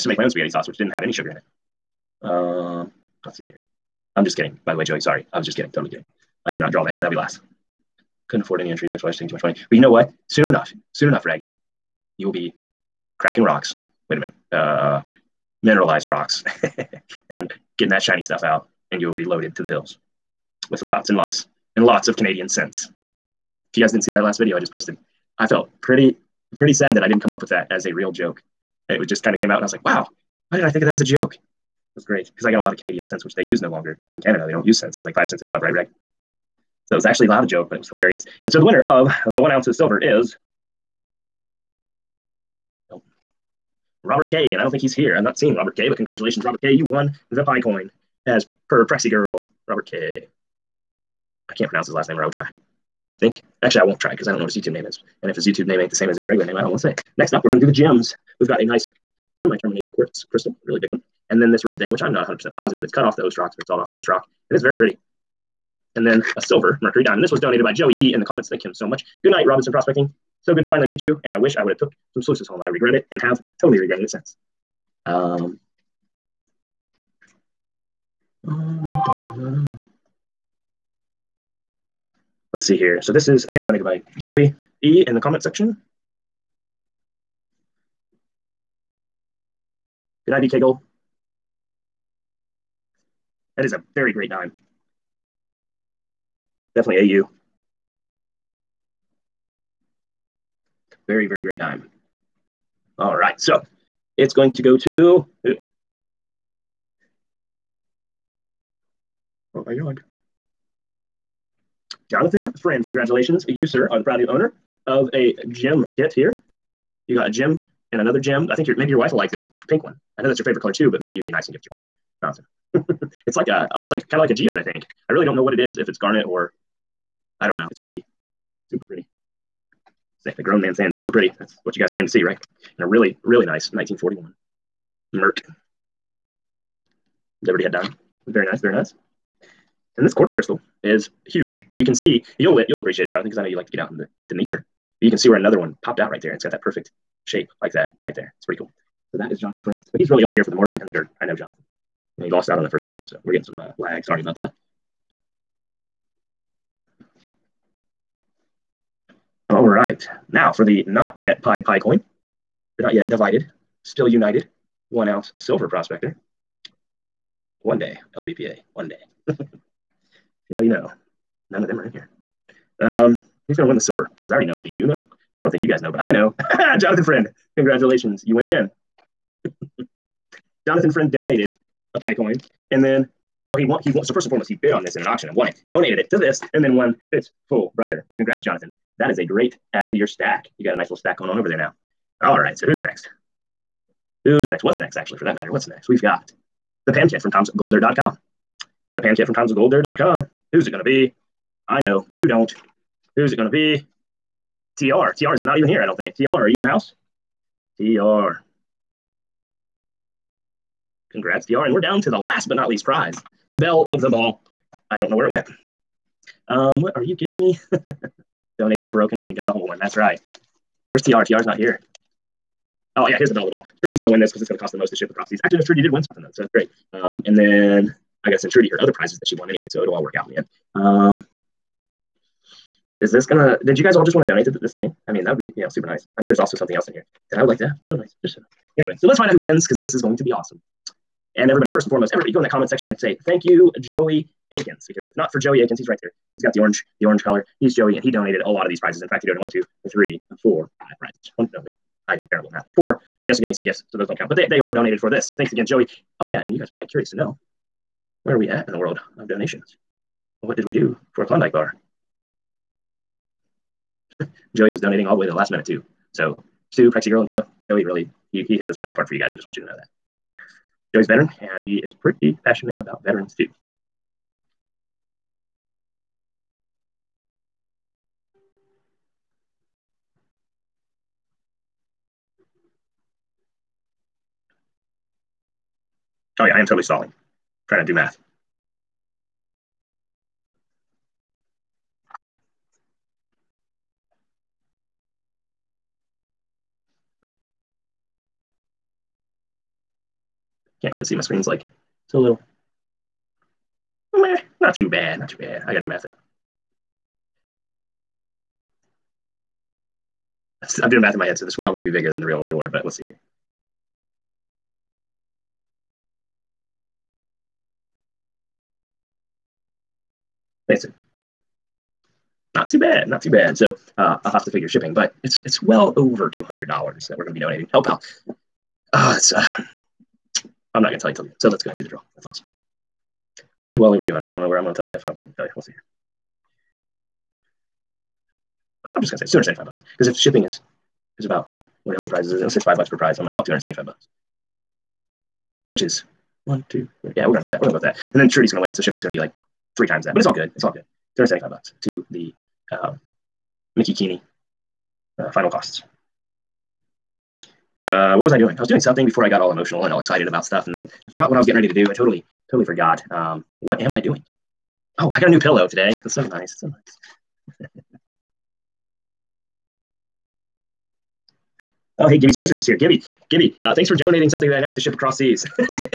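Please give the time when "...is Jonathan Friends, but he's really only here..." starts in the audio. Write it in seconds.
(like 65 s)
149 s.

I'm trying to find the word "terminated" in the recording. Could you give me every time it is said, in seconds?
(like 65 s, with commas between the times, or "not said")
59 s.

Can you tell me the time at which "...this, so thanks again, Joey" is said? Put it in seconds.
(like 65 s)
255 s.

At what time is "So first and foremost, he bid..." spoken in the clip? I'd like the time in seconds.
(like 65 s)
184 s.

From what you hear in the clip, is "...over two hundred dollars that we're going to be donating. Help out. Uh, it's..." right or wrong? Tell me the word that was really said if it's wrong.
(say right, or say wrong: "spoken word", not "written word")
right.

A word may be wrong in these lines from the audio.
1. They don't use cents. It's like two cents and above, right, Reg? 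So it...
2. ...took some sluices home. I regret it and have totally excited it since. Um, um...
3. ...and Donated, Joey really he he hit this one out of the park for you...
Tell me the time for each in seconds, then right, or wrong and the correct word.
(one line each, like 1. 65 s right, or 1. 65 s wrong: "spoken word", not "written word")
1. 34 s wrong: "five", not "two"
2. 71 s wrong: "regretted", not "excited"
3. 267 s wrong: "Dina", not "Donated".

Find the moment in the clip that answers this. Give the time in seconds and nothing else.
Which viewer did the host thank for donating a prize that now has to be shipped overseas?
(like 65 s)
372 s.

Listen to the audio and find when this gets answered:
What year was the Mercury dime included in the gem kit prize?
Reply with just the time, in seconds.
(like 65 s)
133 s.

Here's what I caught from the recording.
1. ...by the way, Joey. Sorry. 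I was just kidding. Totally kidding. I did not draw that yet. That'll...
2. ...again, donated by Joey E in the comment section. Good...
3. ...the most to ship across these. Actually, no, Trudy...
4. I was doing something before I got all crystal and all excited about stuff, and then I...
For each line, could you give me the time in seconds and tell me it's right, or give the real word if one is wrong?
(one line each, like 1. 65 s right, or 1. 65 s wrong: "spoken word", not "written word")
1. 4 s right
2. 83 s right
3. 224 s right
4. 358 s wrong: "emotional", not "crystal".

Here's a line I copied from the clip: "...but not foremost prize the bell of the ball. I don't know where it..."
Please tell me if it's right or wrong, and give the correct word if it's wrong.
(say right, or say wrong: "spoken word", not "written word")
wrong: "least", not "foremost".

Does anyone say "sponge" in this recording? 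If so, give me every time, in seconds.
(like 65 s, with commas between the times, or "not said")
not said.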